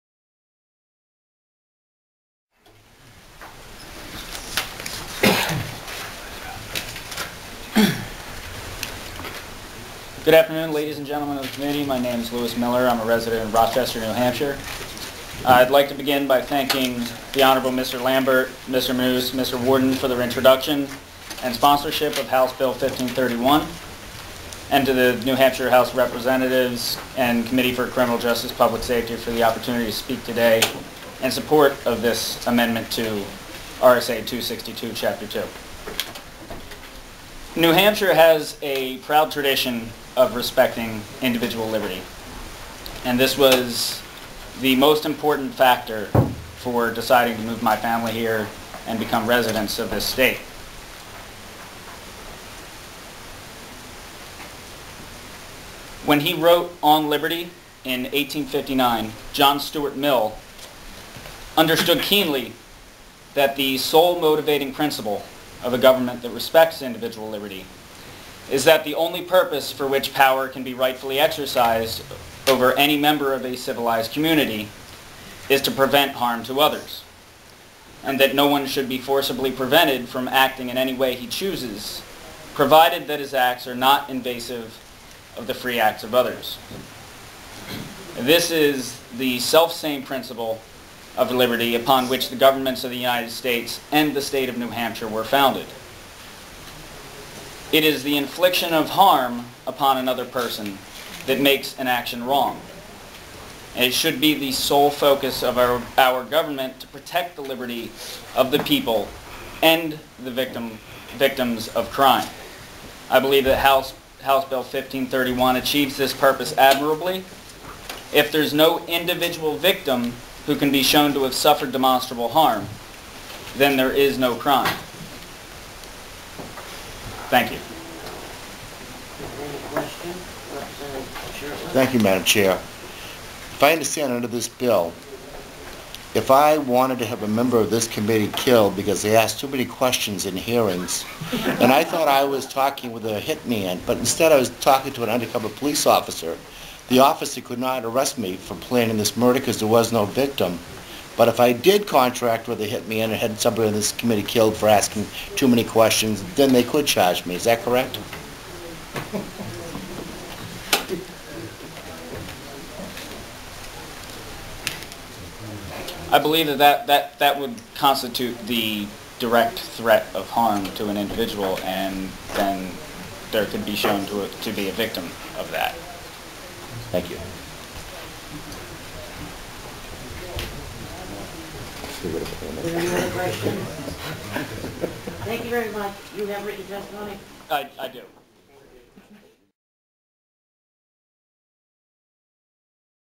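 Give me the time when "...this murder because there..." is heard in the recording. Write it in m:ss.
2:28.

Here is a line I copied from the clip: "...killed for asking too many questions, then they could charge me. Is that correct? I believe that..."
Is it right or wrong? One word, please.
right.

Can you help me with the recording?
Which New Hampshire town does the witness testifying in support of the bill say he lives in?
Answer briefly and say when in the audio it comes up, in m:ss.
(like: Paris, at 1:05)
Rochester, at 0:13.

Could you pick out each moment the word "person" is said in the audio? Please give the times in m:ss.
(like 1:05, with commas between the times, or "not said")
1:40.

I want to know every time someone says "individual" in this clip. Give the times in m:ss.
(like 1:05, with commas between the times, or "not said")
0:41, 1:06, 1:58, 2:50.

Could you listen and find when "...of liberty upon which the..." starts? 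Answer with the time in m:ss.
1:31.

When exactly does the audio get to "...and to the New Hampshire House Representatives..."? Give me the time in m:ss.
0:24.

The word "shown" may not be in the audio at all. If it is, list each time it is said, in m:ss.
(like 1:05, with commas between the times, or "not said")
2:00, 2:53.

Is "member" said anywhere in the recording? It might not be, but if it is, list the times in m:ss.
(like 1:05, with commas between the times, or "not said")
1:12, 2:17.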